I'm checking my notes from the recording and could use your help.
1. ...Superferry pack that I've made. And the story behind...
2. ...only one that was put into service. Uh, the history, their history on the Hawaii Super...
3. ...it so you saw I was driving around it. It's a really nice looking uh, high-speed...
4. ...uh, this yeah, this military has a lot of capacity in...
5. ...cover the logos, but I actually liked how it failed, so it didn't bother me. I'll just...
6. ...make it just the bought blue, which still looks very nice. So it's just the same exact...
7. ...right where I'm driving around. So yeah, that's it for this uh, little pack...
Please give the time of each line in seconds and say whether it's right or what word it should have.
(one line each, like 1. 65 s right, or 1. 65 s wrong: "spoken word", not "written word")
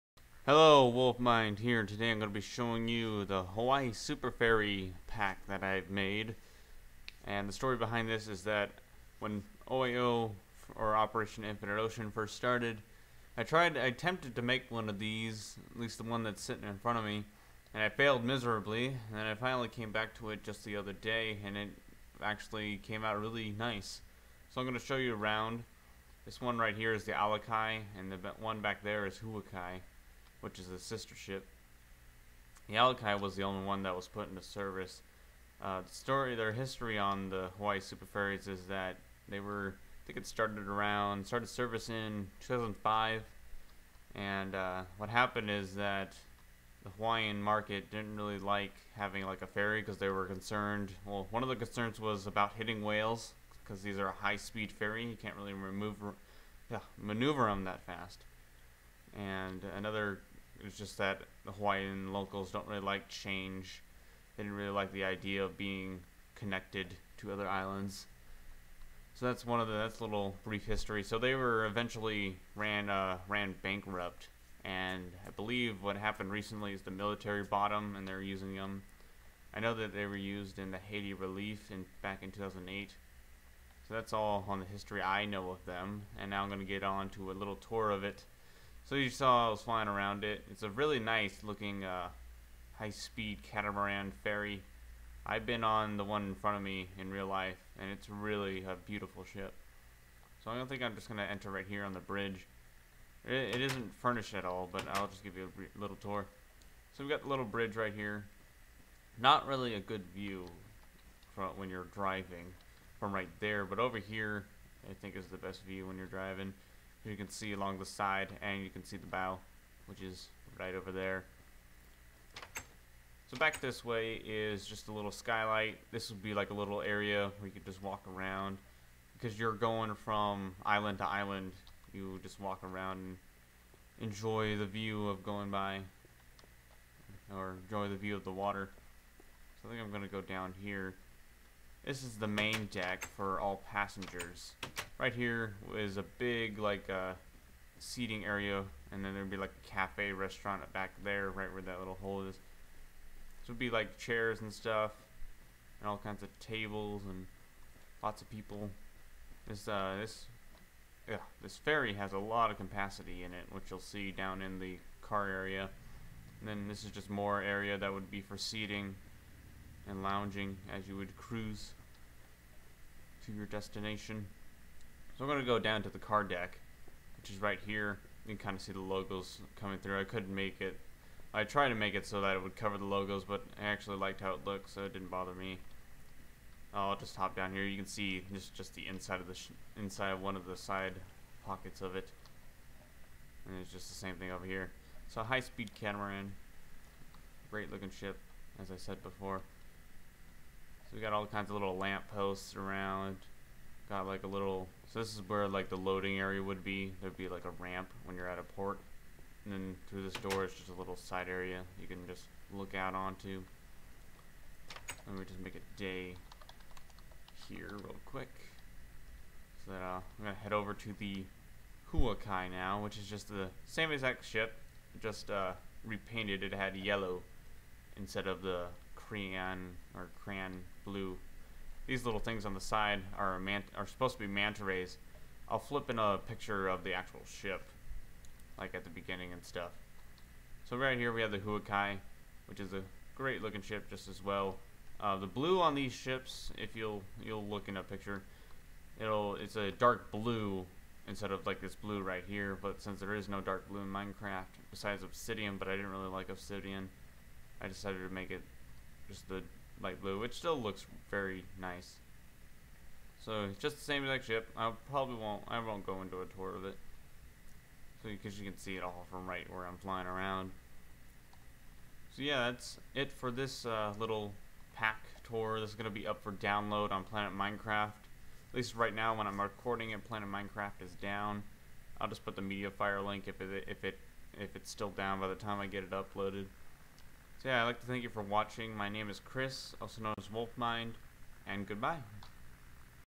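1. 3 s right
2. 33 s wrong: "story", not "history"
3. 88 s wrong: "flying", not "driving"
4. 159 s wrong: "ferry", not "military"
5. 182 s wrong: "looked", not "failed"
6. 258 s wrong: "light", not "bought"
7. 269 s wrong: "flying", not "driving".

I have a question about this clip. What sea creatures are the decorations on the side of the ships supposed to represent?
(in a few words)
Manta rays.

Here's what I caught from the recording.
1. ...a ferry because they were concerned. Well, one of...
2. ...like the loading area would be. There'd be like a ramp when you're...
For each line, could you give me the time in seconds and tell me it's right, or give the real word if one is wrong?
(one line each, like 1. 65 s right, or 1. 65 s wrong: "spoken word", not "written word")
1. 49 s right
2. 205 s right.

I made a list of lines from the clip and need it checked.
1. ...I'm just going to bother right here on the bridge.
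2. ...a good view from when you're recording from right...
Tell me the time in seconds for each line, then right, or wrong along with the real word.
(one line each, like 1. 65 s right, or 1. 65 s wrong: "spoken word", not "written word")
1. 100 s wrong: "enter", not "bother"
2. 109 s wrong: "driving", not "recording".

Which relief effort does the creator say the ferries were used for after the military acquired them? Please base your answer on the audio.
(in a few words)
Haiti relief.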